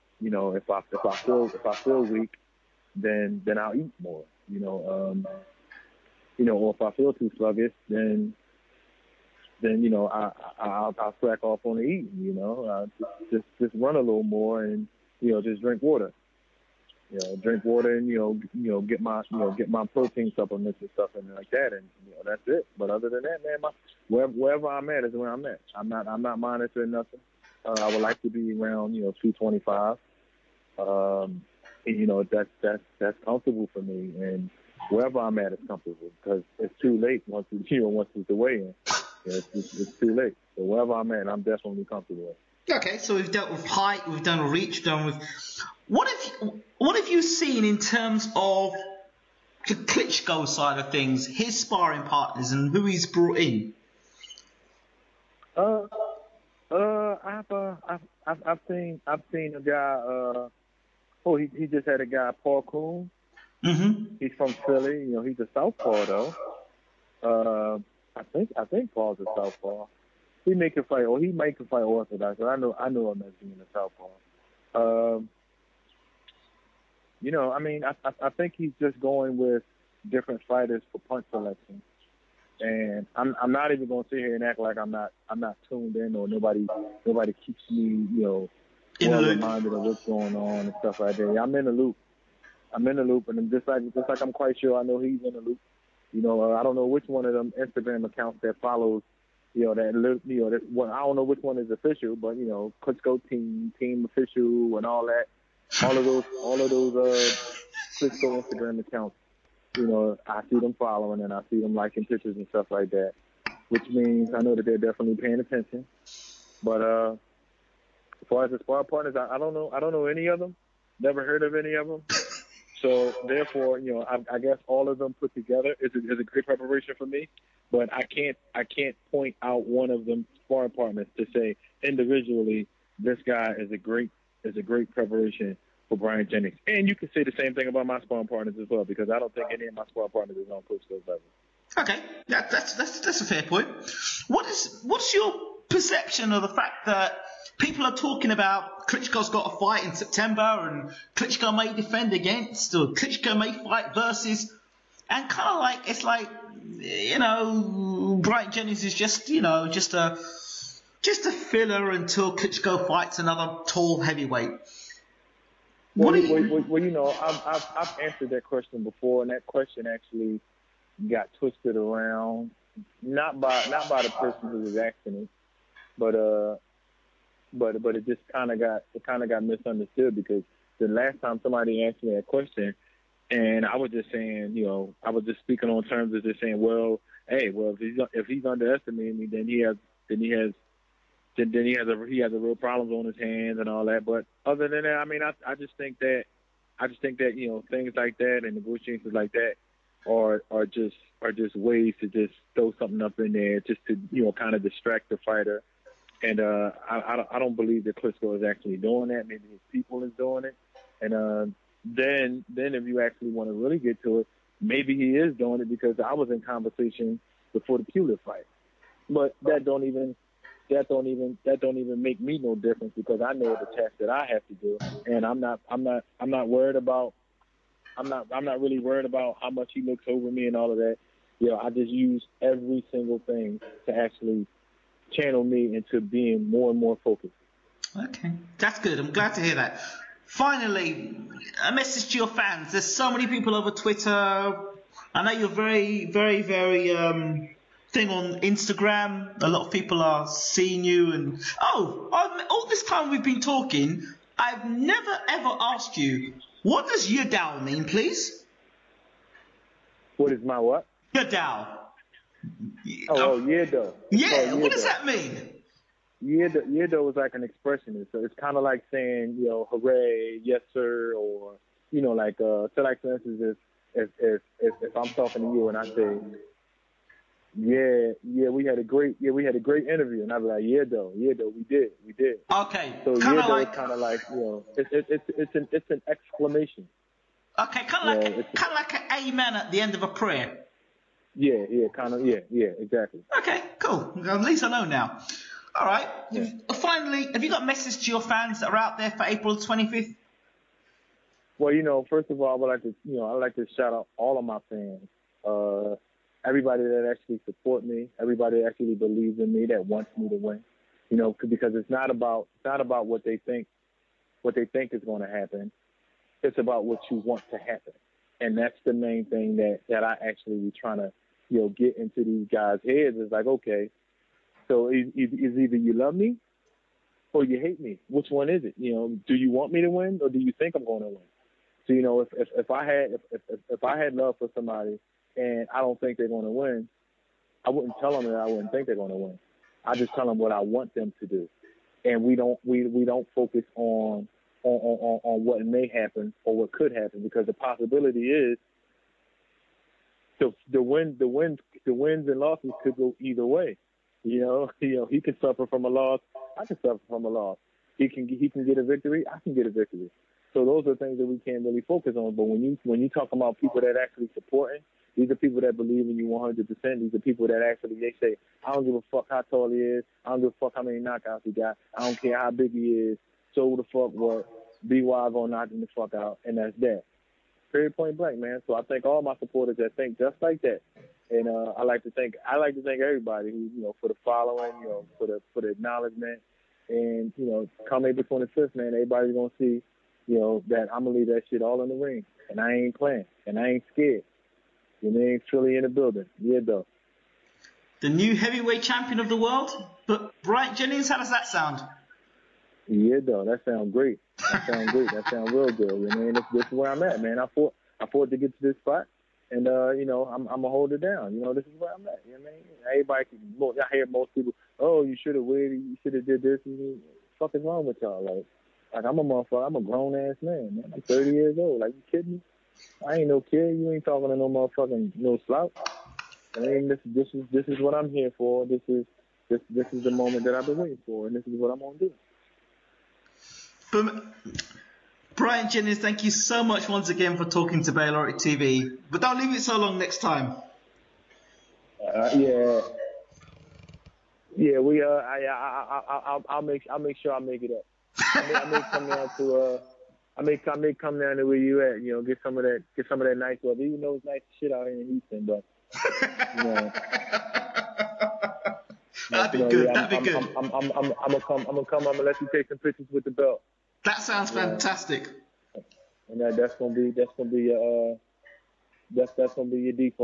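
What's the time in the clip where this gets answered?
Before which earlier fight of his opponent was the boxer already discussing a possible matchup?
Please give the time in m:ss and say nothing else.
3:37.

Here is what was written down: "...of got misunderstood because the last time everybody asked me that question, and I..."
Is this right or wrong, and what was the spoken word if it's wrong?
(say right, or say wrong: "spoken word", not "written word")
wrong: "somebody", not "everybody".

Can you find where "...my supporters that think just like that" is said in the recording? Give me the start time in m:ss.
6:19.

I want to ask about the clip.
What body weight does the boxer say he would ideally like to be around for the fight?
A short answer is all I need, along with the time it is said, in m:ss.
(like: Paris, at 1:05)
225, at 0:29.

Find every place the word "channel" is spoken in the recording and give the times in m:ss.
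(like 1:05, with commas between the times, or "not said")
3:55.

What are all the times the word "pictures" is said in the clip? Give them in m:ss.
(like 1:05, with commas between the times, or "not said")
1:52, 7:42.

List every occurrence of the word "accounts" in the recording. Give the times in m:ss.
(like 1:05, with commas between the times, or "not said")
1:38, 1:48.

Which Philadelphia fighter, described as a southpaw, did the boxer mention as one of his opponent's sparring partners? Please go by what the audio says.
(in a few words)
Paul Coon.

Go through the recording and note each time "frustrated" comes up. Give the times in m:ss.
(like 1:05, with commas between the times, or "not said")
not said.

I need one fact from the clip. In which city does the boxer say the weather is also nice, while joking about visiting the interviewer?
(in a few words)
Houston.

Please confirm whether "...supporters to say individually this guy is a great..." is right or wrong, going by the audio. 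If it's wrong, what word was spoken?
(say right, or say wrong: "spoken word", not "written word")
wrong: "partners", not "supporters".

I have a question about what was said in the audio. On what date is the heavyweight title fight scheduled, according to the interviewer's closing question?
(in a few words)
April 25.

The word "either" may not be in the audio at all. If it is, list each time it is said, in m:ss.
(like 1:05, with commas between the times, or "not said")
5:25, 5:53.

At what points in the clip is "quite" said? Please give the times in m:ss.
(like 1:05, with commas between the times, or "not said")
1:34.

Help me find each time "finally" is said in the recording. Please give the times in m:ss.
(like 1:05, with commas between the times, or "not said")
4:00, 4:56.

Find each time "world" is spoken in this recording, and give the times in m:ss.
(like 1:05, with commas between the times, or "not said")
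6:39.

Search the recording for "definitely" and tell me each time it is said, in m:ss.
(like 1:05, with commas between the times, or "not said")
0:41, 1:54.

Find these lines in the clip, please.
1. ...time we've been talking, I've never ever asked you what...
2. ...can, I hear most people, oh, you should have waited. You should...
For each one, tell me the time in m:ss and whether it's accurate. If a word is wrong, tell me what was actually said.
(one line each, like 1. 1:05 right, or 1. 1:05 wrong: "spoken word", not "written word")
1. 4:12 right
2. 6:53 right.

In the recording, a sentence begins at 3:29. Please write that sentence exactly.
Maybe his people is doing it.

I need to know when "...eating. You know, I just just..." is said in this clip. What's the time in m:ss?
0:11.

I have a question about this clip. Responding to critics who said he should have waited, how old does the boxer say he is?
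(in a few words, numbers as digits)
30.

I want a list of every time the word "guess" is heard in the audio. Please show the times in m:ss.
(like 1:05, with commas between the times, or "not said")
2:04.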